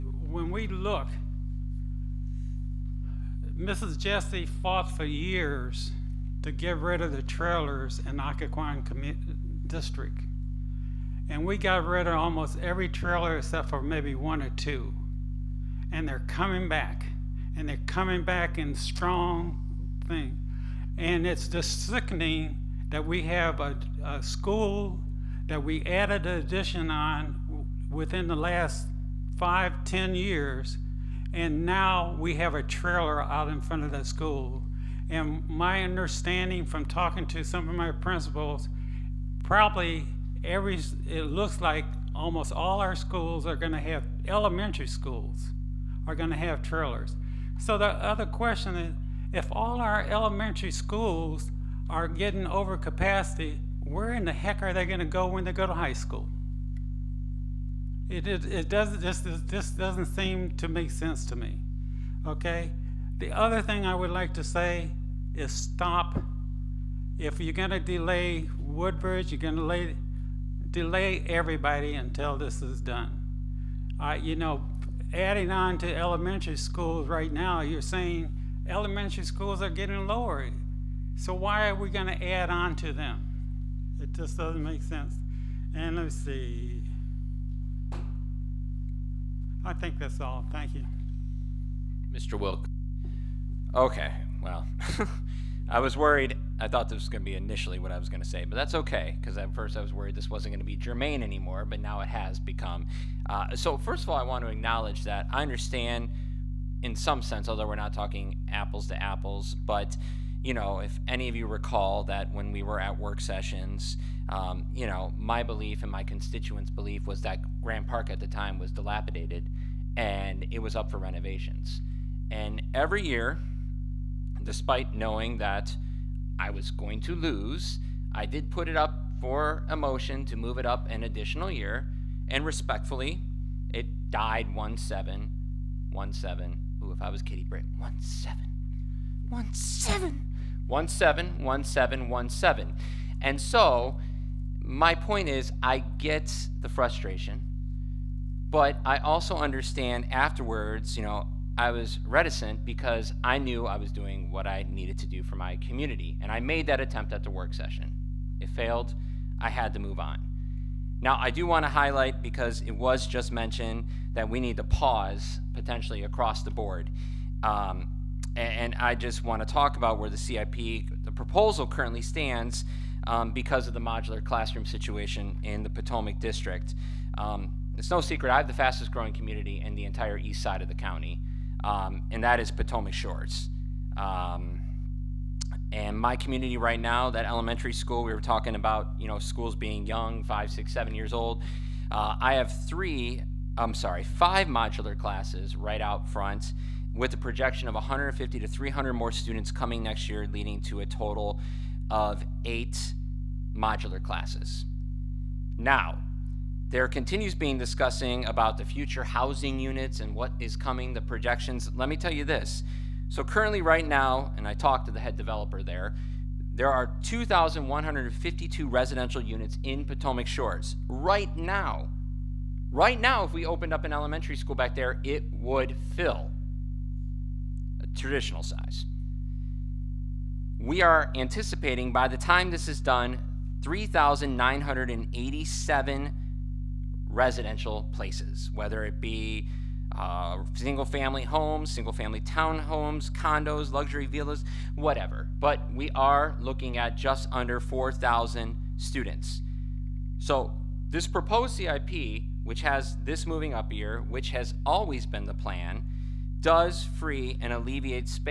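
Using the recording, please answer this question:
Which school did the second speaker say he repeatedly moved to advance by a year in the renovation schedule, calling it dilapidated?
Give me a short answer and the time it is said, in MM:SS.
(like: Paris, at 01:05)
Graham Park, at 01:57.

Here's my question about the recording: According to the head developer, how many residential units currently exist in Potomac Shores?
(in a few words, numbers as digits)
2,152.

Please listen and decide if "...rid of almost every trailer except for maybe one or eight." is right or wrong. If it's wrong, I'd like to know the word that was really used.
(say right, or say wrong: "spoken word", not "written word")
wrong: "two", not "eight".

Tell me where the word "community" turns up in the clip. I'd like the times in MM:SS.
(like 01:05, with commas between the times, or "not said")
02:35, 02:59, 03:06.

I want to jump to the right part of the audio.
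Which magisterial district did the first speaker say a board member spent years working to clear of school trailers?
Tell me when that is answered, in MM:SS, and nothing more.
00:08.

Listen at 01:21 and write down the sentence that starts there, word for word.
So why are we going to add on to them?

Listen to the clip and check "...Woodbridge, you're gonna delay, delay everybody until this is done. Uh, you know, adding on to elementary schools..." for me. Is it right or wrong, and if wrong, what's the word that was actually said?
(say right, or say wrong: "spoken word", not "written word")
right.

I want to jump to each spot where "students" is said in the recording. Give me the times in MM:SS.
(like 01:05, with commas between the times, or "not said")
03:19, 04:08.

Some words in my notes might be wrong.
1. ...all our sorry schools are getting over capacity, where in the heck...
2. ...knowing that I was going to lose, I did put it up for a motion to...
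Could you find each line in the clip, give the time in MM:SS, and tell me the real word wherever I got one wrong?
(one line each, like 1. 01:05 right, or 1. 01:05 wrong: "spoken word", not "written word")
1. 00:49 wrong: "elementary", not "sorry"
2. 02:04 right.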